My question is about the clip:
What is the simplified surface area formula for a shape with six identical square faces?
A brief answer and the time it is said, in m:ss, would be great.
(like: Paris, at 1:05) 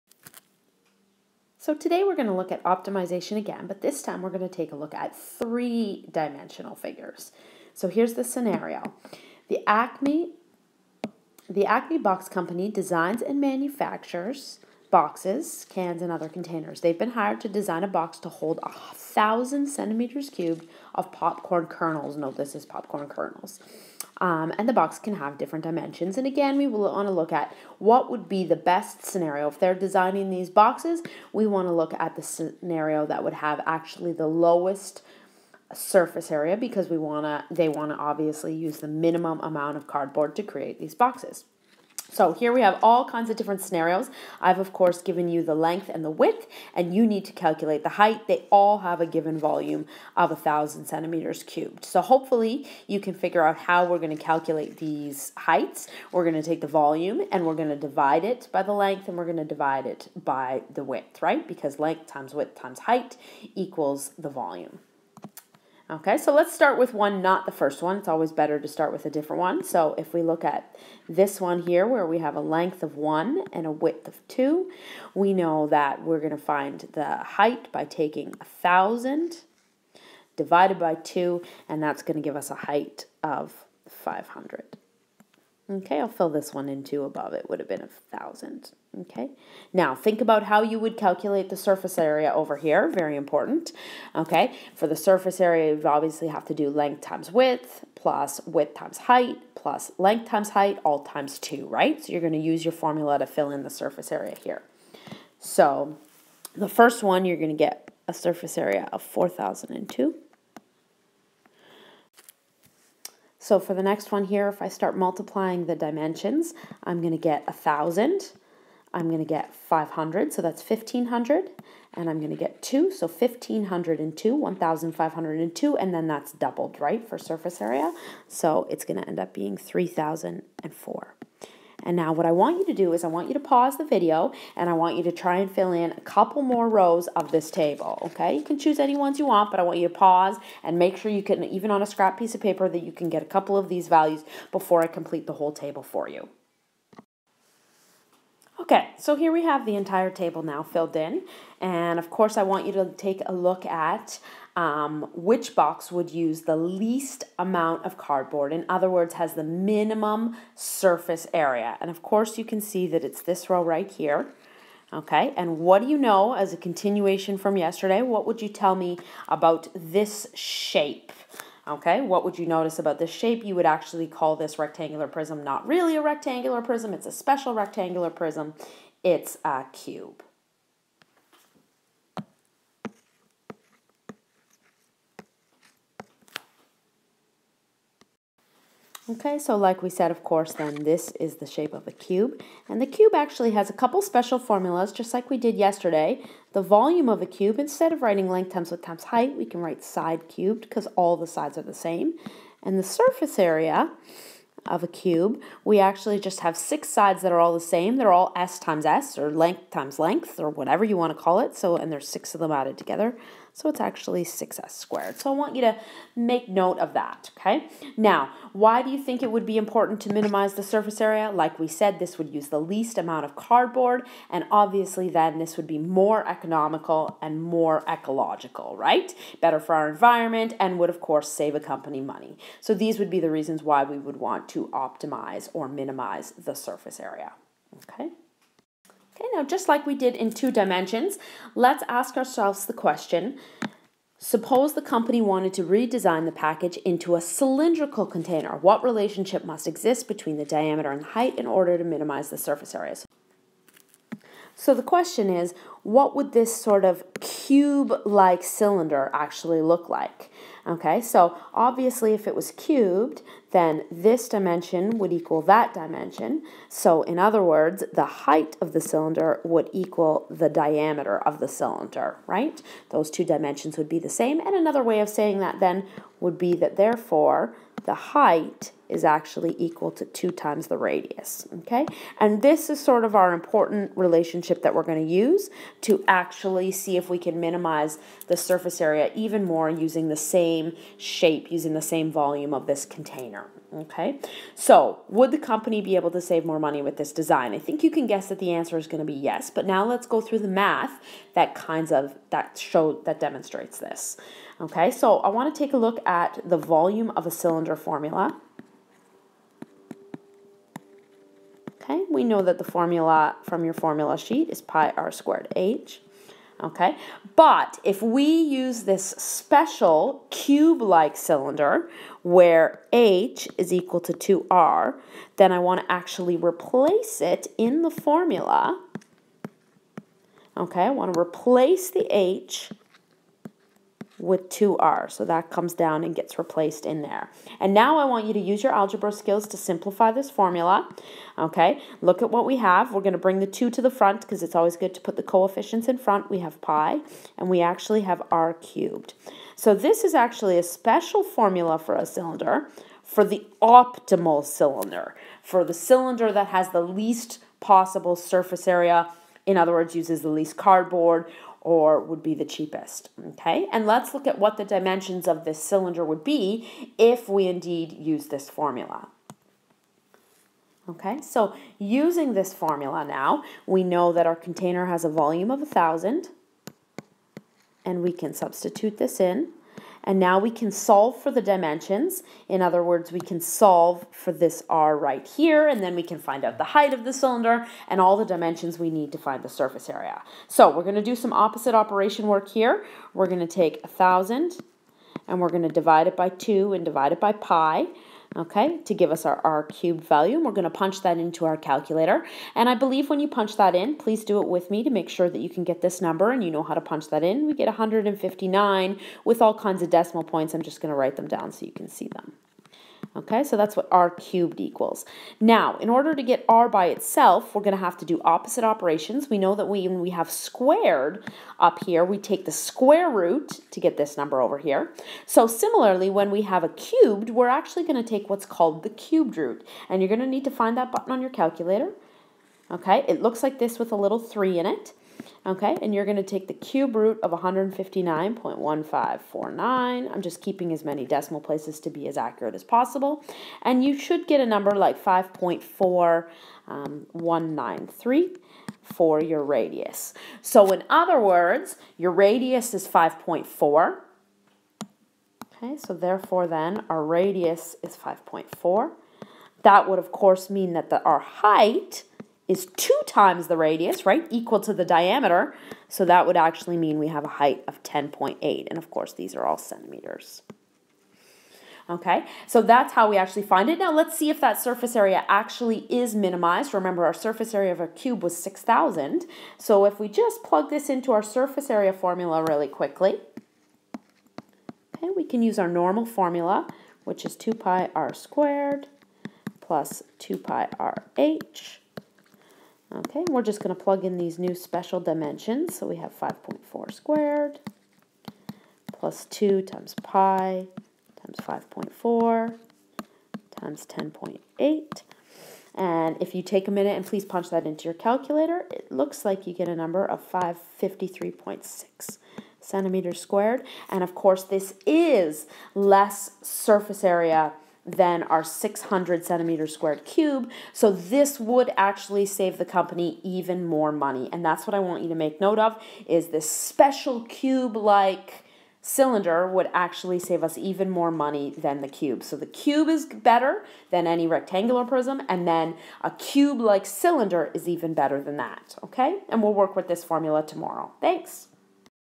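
6s squared, at 3:34.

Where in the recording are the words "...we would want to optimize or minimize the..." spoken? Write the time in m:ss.
3:53.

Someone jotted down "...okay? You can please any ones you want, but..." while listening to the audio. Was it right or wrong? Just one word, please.
wrong.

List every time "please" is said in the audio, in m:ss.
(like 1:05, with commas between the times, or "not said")
6:43, 8:27.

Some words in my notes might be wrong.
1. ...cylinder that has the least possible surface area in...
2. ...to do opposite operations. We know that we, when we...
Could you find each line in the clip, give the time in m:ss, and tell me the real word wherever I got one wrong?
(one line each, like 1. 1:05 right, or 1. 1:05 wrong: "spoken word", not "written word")
1. 5:55 right
2. 6:57 right.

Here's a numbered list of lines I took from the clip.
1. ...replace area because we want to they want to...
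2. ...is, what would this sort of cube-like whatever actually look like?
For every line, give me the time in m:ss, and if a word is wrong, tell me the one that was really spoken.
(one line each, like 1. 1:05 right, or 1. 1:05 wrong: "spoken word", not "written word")
1. 0:35 wrong: "surface", not "replace"
2. 4:15 wrong: "cylinder", not "whatever".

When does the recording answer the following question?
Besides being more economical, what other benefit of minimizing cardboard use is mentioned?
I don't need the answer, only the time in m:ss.
3:47.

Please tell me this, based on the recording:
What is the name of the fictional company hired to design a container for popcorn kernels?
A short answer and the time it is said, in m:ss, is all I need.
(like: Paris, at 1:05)
Acme Box Company, at 0:11.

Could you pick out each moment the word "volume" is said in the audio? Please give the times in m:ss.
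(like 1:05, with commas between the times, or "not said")
0:49, 0:56, 1:04, 3:16, 4:52, 5:06, 6:15.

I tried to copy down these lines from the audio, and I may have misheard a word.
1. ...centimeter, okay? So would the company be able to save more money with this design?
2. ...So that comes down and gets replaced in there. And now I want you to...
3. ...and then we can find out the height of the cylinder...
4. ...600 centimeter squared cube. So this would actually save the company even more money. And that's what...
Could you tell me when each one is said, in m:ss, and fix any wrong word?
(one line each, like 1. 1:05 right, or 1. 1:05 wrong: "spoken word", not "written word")
1. 4:52 wrong: "container", not "centimeter"
2. 5:35 right
3. 6:25 right
4. 8:38 right.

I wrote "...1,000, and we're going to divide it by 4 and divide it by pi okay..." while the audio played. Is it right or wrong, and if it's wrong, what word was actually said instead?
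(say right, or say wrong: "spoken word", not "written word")
wrong: "2", not "4".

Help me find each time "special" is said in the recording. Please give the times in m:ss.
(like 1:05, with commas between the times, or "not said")
2:57, 3:14, 5:19, 5:50, 8:14, 8:46.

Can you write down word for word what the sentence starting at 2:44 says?
Okay, and what do you know as a continuation from yesterday?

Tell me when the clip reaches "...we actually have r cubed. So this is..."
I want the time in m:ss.
5:47.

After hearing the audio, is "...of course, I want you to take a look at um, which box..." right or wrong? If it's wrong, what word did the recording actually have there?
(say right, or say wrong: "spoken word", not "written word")
right.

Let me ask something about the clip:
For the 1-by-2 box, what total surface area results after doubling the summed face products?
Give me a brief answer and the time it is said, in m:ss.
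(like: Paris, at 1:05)
3,004, at 2:09.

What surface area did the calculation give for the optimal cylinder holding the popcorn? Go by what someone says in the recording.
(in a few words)
553.6 square centimeters.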